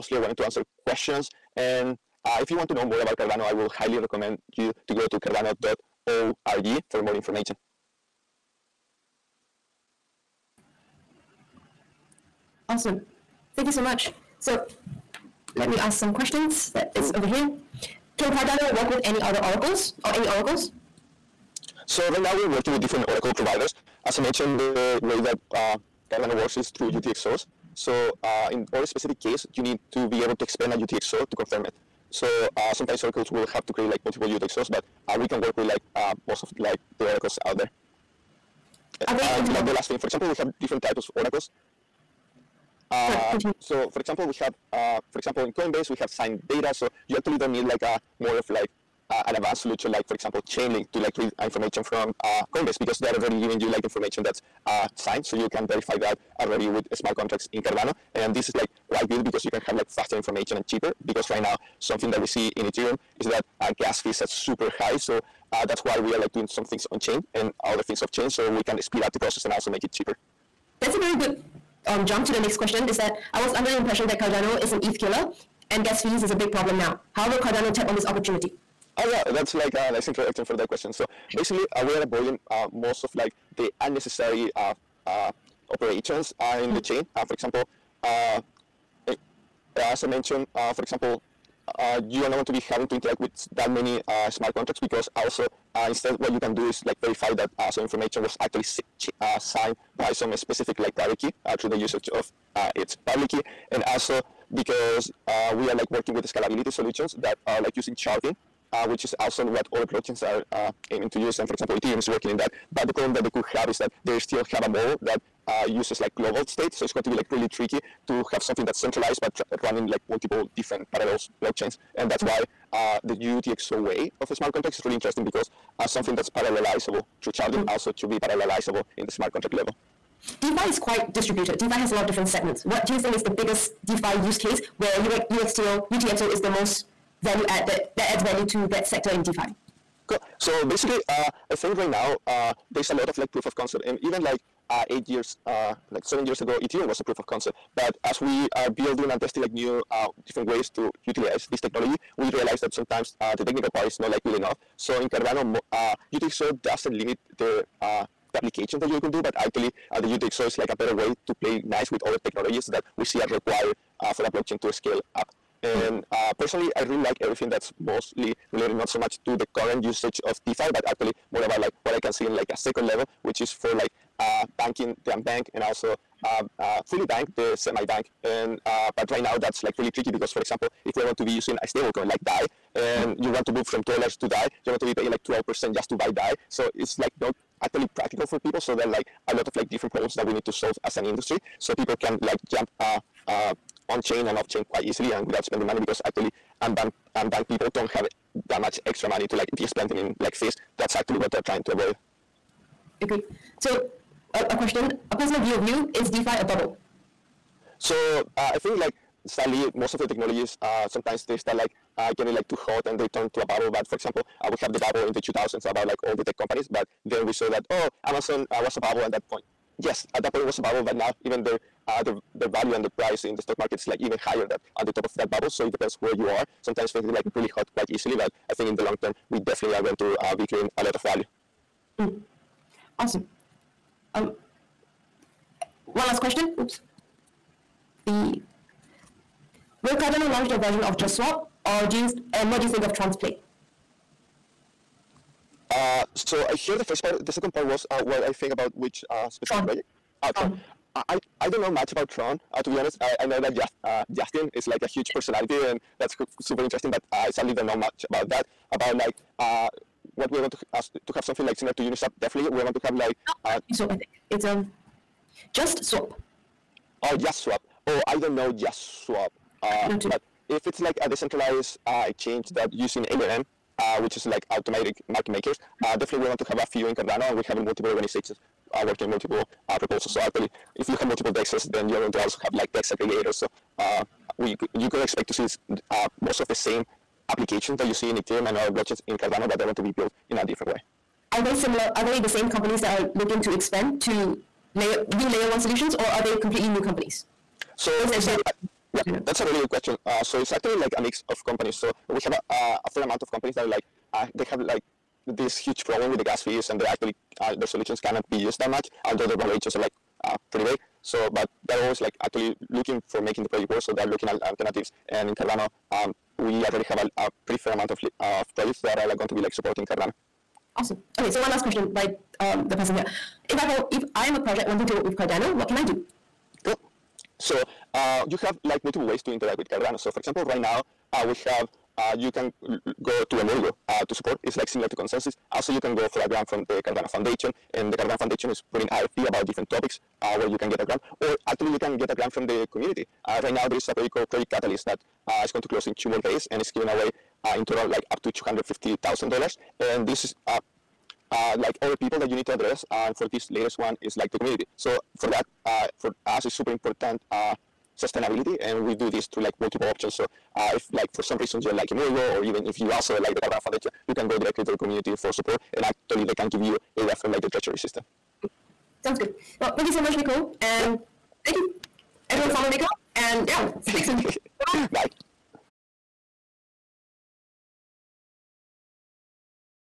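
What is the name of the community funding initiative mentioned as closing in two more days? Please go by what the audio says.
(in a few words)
Project Catalyst.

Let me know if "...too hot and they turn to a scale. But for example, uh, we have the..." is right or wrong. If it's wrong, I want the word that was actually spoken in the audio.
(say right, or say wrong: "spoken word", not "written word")
wrong: "bubble", not "scale".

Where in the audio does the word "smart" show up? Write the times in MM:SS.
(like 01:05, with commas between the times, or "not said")
00:56, 01:34, 02:04, 02:09.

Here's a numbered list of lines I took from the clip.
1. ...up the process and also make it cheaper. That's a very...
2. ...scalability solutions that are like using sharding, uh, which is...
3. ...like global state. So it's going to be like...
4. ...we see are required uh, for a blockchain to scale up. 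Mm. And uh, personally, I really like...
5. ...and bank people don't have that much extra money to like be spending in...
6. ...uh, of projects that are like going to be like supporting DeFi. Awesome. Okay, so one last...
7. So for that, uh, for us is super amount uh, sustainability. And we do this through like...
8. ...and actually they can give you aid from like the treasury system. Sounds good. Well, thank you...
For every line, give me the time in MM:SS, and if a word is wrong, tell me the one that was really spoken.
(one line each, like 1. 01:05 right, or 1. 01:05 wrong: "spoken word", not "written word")
1. 01:09 right
2. 01:46 right
3. 01:55 right
4. 02:42 right
5. 03:16 right
6. 05:18 wrong: "Cardano", not "DeFi"
7. 05:54 wrong: "important", not "amount"
8. 06:05 right.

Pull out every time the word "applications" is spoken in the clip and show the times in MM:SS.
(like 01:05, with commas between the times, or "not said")
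02:38, 04:47.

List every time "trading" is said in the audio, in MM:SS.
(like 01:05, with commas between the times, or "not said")
not said.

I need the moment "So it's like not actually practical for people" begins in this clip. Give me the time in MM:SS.
03:06.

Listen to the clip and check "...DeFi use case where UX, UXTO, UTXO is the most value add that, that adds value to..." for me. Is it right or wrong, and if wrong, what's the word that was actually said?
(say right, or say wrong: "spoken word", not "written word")
right.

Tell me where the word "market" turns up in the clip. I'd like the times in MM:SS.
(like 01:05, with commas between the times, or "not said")
03:43, 04:35.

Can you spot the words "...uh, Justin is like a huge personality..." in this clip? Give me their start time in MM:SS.
04:13.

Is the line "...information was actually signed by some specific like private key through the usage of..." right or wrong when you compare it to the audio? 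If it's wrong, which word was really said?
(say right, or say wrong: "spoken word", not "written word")
right.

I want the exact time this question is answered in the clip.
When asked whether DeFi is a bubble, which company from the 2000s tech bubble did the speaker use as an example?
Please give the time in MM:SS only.
03:38.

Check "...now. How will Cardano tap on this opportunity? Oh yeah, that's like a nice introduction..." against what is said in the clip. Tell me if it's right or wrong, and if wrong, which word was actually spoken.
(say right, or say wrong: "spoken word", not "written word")
right.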